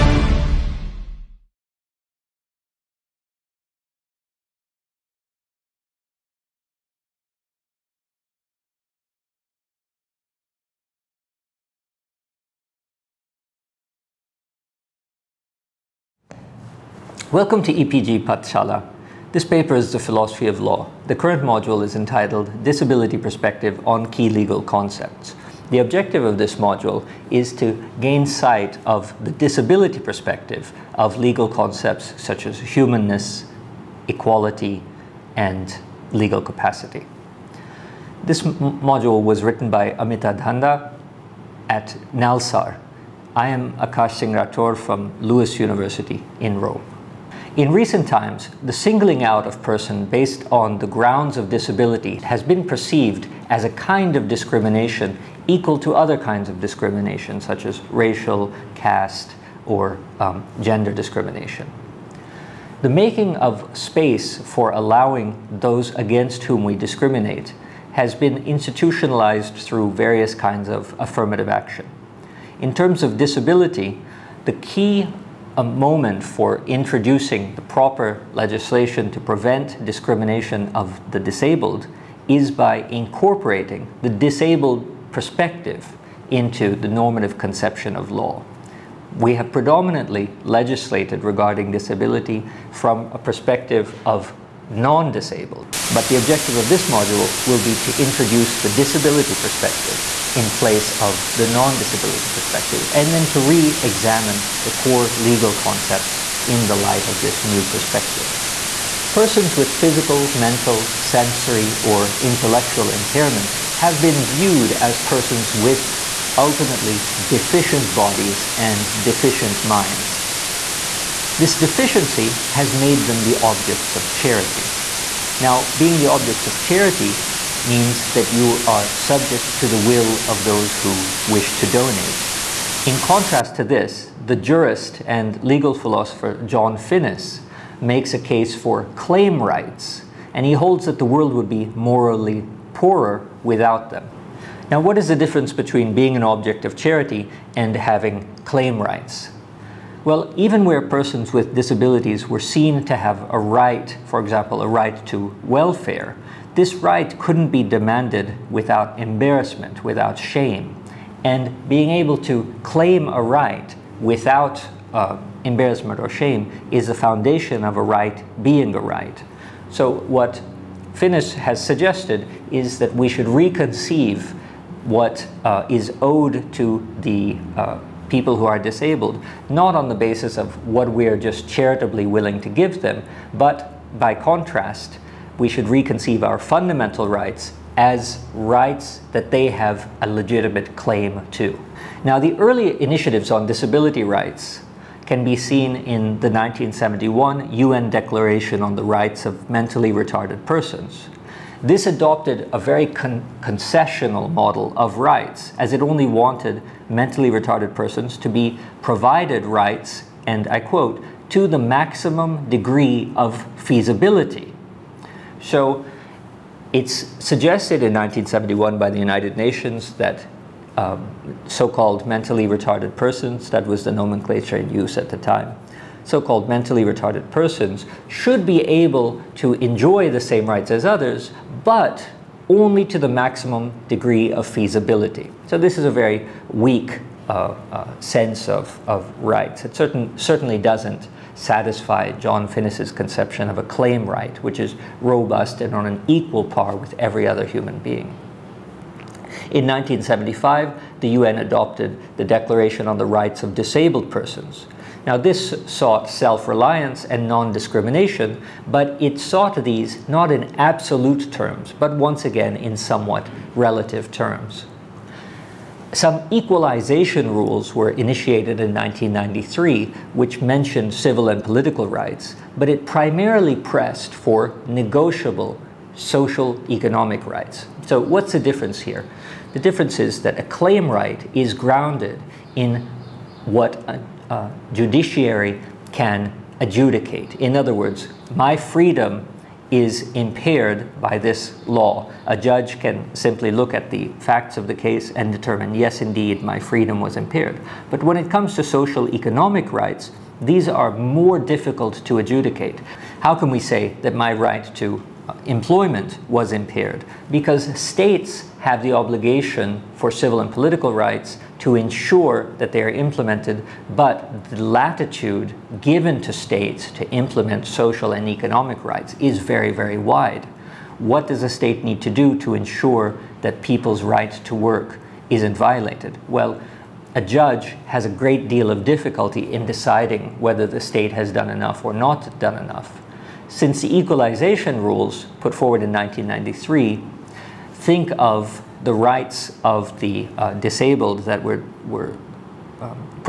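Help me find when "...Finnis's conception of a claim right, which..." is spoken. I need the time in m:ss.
4:02.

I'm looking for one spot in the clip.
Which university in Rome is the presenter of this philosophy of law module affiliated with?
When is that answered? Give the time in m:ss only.
0:45.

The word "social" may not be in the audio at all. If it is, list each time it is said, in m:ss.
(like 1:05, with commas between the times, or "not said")
4:35, 4:58, 5:17.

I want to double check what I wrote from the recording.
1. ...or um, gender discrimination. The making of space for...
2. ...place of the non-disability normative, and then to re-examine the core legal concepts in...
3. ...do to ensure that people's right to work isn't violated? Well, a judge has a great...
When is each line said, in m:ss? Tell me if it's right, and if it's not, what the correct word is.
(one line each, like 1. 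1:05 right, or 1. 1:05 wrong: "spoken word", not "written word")
1. 0:59 right
2. 1:40 wrong: "perspective", not "normative"
3. 5:22 right.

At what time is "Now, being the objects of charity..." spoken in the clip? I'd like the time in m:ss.
2:05.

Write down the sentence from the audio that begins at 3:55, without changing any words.
So this is a very weak uh, uh, sense of, of rights.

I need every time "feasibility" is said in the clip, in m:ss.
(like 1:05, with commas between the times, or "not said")
3:33, 3:54.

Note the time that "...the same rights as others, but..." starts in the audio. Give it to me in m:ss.
3:50.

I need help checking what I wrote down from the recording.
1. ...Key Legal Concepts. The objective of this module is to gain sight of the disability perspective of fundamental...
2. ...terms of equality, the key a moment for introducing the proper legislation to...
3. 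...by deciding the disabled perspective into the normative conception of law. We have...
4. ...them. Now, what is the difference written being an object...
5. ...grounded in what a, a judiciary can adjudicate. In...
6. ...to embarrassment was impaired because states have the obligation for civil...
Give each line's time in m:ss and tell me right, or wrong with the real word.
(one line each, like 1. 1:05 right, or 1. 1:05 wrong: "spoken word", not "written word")
1. 0:24 wrong: "legal", not "fundamental"
2. 1:12 wrong: "disability", not "equality"
3. 1:22 wrong: "incorporating", not "deciding"
4. 2:23 wrong: "between", not "written"
5. 4:41 right
6. 5:04 wrong: "employment", not "embarrassment".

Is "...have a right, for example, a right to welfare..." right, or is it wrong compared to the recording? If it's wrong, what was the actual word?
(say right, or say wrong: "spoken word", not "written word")
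right.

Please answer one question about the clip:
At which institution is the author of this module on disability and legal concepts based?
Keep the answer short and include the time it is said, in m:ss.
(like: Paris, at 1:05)
NALSAR, at 0:42.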